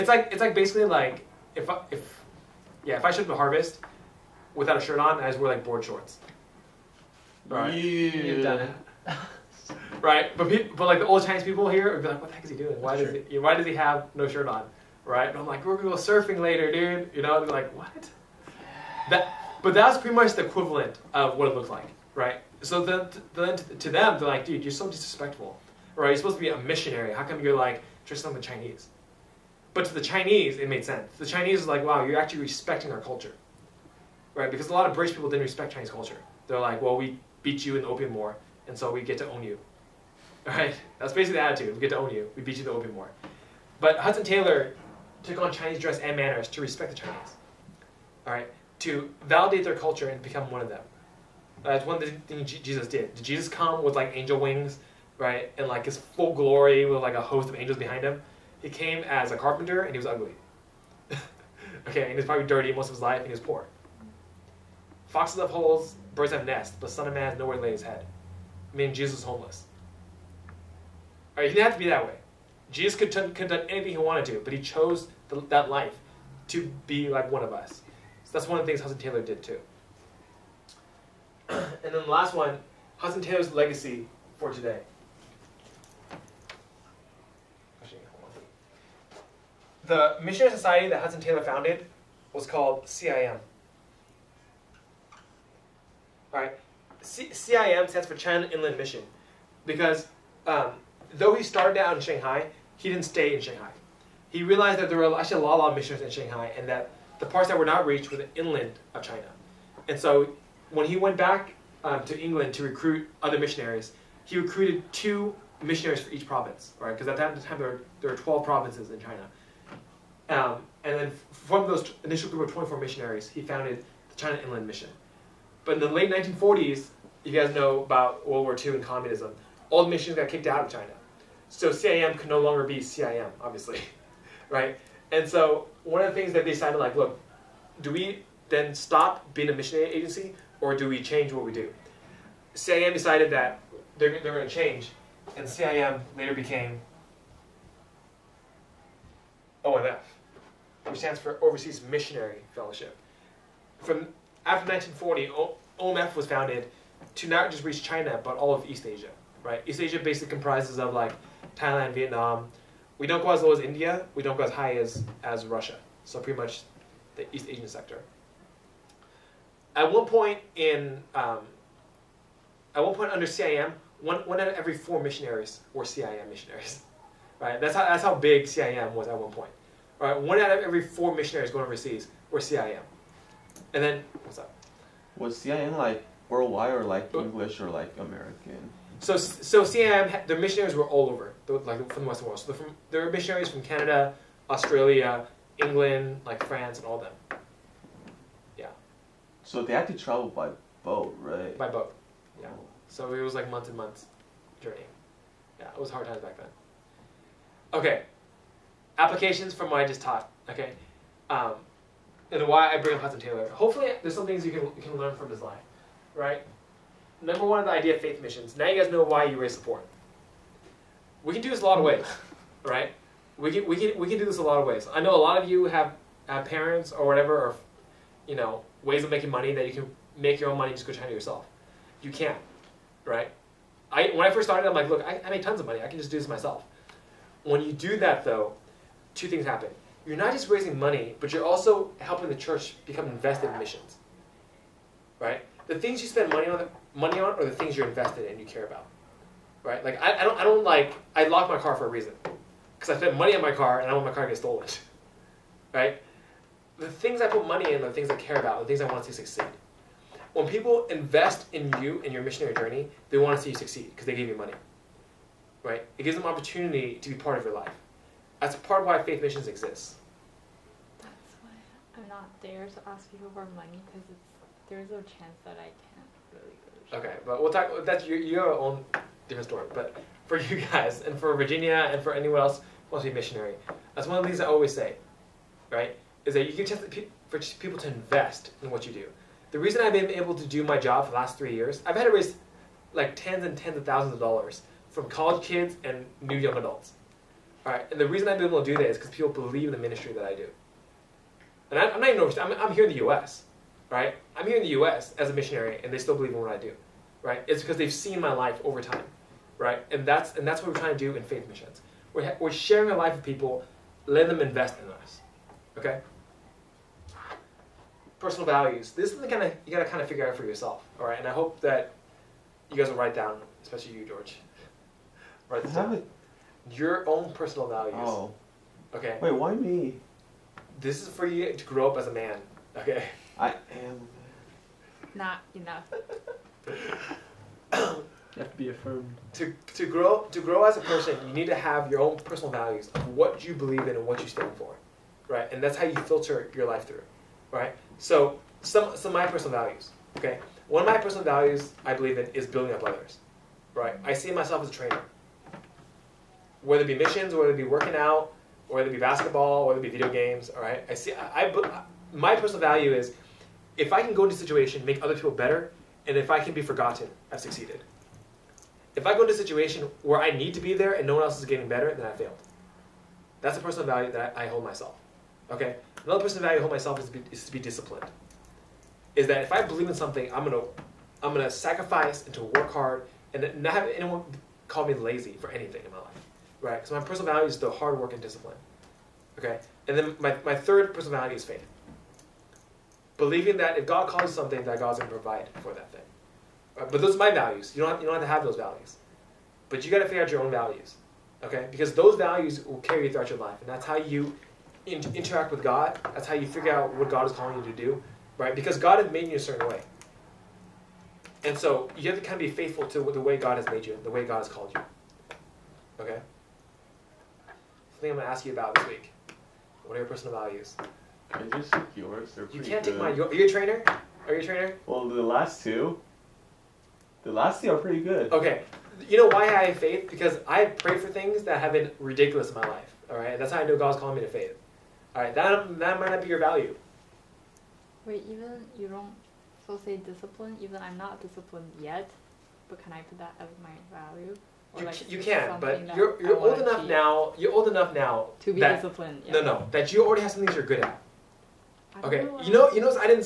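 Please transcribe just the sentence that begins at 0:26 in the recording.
You're supposed to be a missionary.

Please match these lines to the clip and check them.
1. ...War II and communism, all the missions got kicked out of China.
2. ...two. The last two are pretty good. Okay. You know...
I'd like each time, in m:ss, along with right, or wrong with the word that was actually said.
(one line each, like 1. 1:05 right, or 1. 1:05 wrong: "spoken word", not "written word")
1. 2:08 right
2. 7:05 right.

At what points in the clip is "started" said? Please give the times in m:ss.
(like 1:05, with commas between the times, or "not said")
1:41, 3:54.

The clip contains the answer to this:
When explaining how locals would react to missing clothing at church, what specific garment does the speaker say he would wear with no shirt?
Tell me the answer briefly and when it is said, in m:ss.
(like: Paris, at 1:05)
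board shorts, at 0:05.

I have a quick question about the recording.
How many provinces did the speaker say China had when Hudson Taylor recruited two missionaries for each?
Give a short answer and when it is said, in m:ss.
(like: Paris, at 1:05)
12, at 1:58.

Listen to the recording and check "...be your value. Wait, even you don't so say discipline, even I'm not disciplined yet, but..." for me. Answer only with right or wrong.
right.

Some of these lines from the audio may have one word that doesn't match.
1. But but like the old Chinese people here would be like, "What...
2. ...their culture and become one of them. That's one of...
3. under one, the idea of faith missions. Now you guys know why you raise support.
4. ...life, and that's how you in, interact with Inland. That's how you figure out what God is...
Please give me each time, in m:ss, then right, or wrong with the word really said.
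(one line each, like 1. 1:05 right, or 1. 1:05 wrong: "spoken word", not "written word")
1. 0:10 right
2. 0:49 right
3. 3:37 wrong: "number", not "under"
4. 6:43 wrong: "God", not "Inland".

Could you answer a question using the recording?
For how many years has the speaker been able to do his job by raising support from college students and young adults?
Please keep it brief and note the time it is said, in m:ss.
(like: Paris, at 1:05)
3, at 4:51.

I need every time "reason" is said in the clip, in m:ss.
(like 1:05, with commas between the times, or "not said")
4:11, 4:49, 4:58.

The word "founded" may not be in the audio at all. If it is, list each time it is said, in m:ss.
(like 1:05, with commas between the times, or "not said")
1:31, 2:03, 2:36.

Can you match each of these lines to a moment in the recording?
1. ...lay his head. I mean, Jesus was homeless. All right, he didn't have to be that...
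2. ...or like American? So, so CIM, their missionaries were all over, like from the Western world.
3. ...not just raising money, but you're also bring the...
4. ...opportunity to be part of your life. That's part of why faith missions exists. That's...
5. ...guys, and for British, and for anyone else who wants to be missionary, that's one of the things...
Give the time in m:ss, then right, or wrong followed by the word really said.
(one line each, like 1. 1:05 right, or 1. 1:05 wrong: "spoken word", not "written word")
1. 1:07 right
2. 3:07 right
3. 4:00 wrong: "helping", not "bring"
4. 4:26 right
5. 4:40 wrong: "Virginia", not "British".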